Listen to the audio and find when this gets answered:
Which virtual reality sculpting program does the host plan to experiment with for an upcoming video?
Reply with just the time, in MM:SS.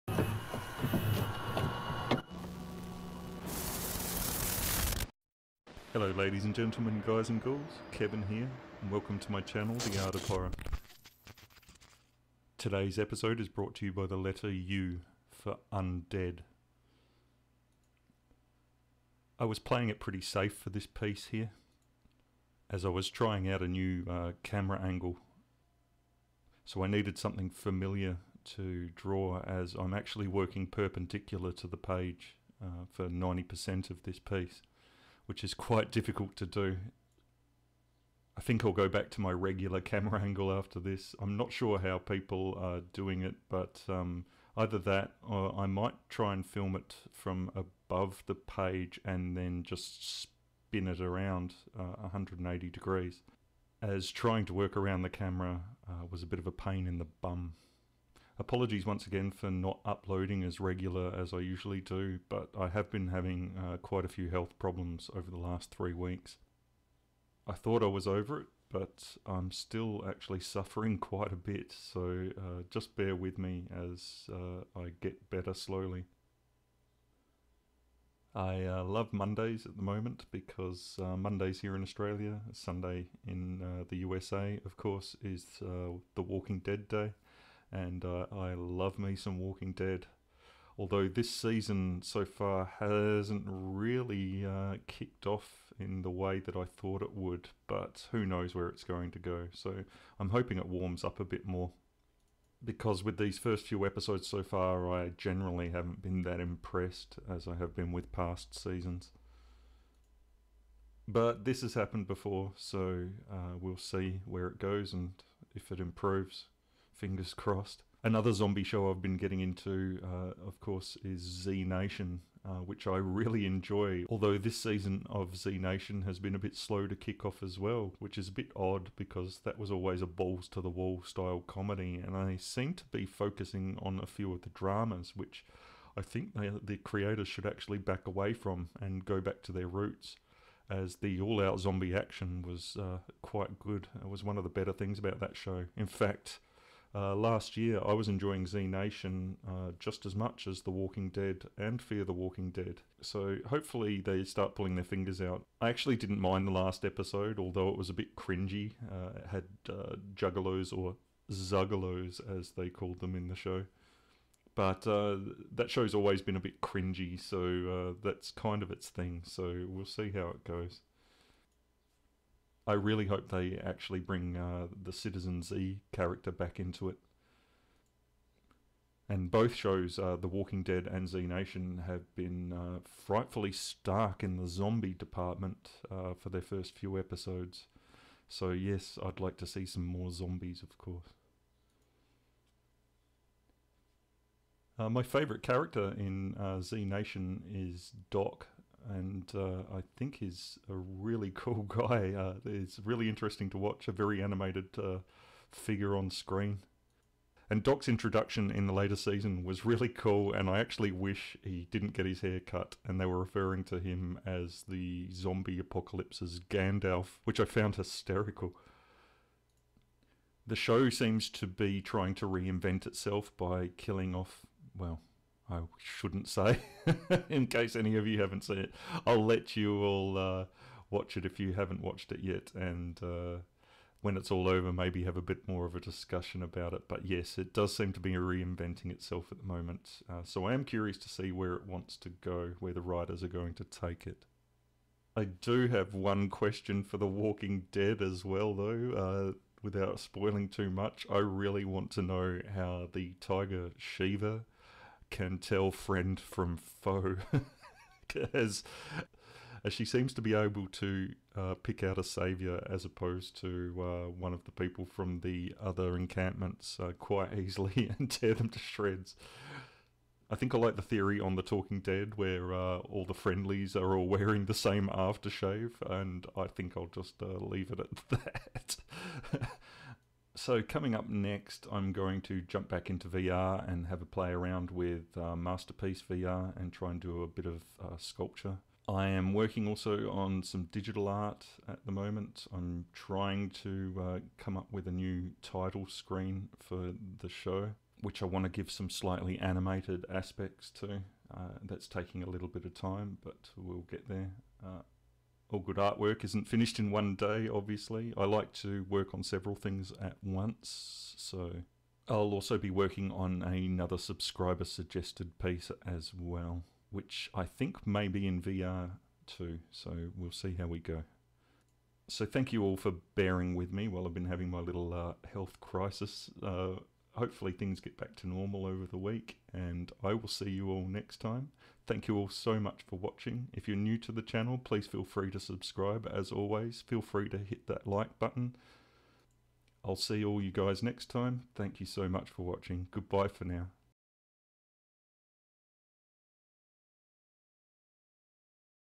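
04:45.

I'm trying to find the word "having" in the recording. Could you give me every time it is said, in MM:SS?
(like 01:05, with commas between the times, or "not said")
01:03, 05:24.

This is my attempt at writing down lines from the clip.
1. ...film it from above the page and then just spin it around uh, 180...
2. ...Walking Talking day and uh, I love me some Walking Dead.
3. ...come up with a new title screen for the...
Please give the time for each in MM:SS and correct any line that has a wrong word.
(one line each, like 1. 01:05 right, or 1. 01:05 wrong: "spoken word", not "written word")
1. 00:46 right
2. 01:26 wrong: "Dead", not "Talking"
3. 04:54 right.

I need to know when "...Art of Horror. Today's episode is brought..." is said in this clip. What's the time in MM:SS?
00:10.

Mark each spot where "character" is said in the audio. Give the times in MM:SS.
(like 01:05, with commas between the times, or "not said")
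02:55, 03:15.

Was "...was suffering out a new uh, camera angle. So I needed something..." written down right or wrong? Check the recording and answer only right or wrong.
wrong.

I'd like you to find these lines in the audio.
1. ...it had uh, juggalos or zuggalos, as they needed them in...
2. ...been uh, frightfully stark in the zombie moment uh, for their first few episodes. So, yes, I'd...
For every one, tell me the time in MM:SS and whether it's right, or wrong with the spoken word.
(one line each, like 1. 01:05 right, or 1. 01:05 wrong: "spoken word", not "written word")
1. 02:39 wrong: "called", not "needed"
2. 03:02 wrong: "department", not "moment".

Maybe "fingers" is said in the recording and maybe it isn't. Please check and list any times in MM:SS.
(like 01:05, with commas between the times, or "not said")
01:57, 02:34.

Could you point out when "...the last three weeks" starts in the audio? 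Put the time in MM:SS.
01:05.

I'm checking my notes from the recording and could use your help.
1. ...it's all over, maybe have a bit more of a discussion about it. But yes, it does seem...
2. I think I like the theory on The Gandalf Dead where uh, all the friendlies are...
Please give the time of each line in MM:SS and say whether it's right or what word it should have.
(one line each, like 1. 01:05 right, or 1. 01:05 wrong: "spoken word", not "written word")
1. 03:54 right
2. 04:30 wrong: "Talking", not "Gandalf".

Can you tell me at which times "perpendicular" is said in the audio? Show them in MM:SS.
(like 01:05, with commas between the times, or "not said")
00:30.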